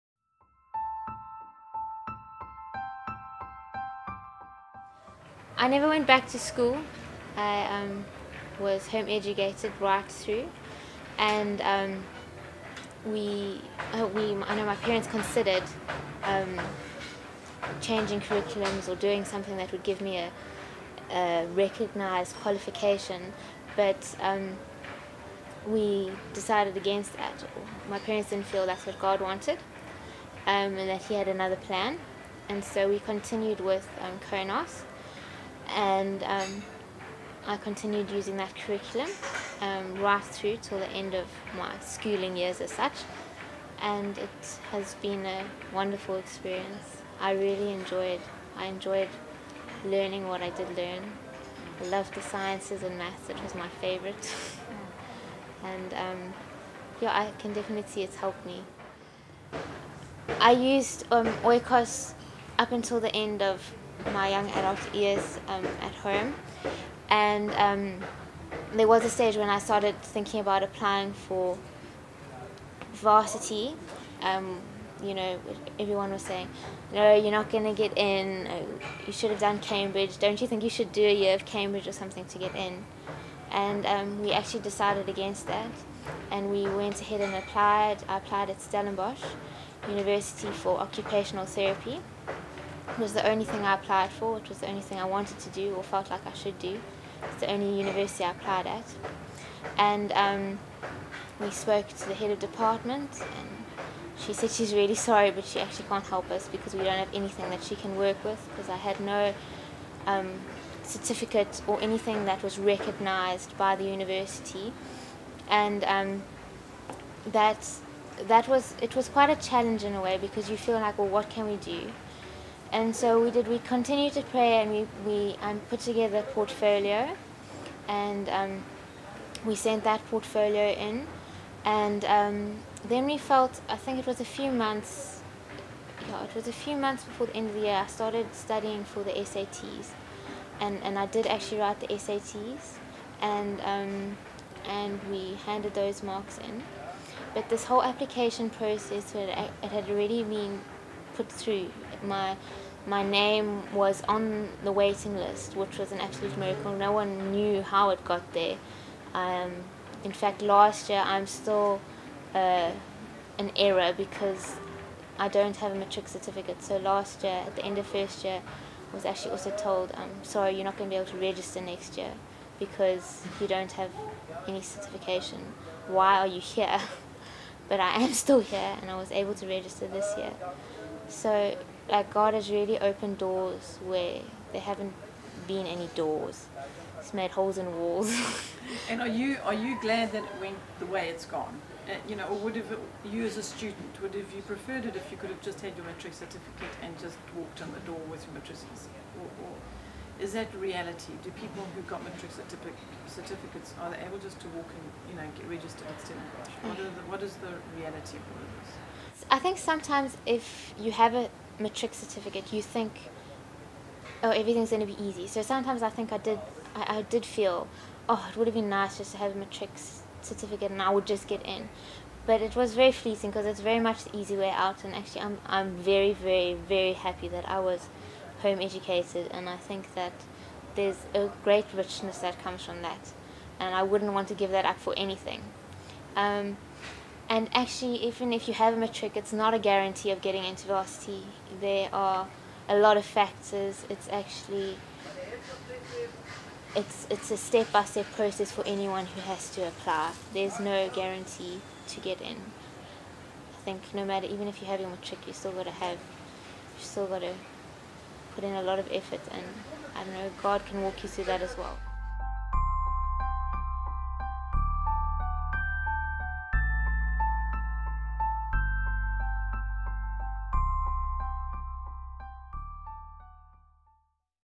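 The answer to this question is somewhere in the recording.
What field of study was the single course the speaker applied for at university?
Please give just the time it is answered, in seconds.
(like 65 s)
90 s.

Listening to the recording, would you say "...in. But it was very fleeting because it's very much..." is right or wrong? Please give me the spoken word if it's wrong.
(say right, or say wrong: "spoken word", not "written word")
right.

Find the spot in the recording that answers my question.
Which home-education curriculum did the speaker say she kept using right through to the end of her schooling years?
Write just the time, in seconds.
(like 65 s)
34 s.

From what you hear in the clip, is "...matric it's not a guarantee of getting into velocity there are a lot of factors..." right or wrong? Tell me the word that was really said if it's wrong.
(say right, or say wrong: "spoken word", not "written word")
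right.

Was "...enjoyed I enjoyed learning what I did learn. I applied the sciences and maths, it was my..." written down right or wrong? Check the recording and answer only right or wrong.
wrong.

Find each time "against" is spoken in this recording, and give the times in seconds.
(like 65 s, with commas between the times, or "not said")
26 s, 85 s.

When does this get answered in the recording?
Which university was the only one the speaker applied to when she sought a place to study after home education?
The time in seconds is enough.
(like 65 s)
88 s.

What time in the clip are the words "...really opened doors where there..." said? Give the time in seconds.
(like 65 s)
182 s.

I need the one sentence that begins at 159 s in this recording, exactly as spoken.
Um, in fact, last year I'm still uh, an error because I don't have a matric certificate.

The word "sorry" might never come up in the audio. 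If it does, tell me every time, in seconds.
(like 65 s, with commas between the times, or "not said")
104 s, 170 s.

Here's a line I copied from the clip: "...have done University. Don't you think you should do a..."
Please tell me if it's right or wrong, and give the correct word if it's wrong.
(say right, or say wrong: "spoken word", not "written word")
wrong: "Cambridge", not "University".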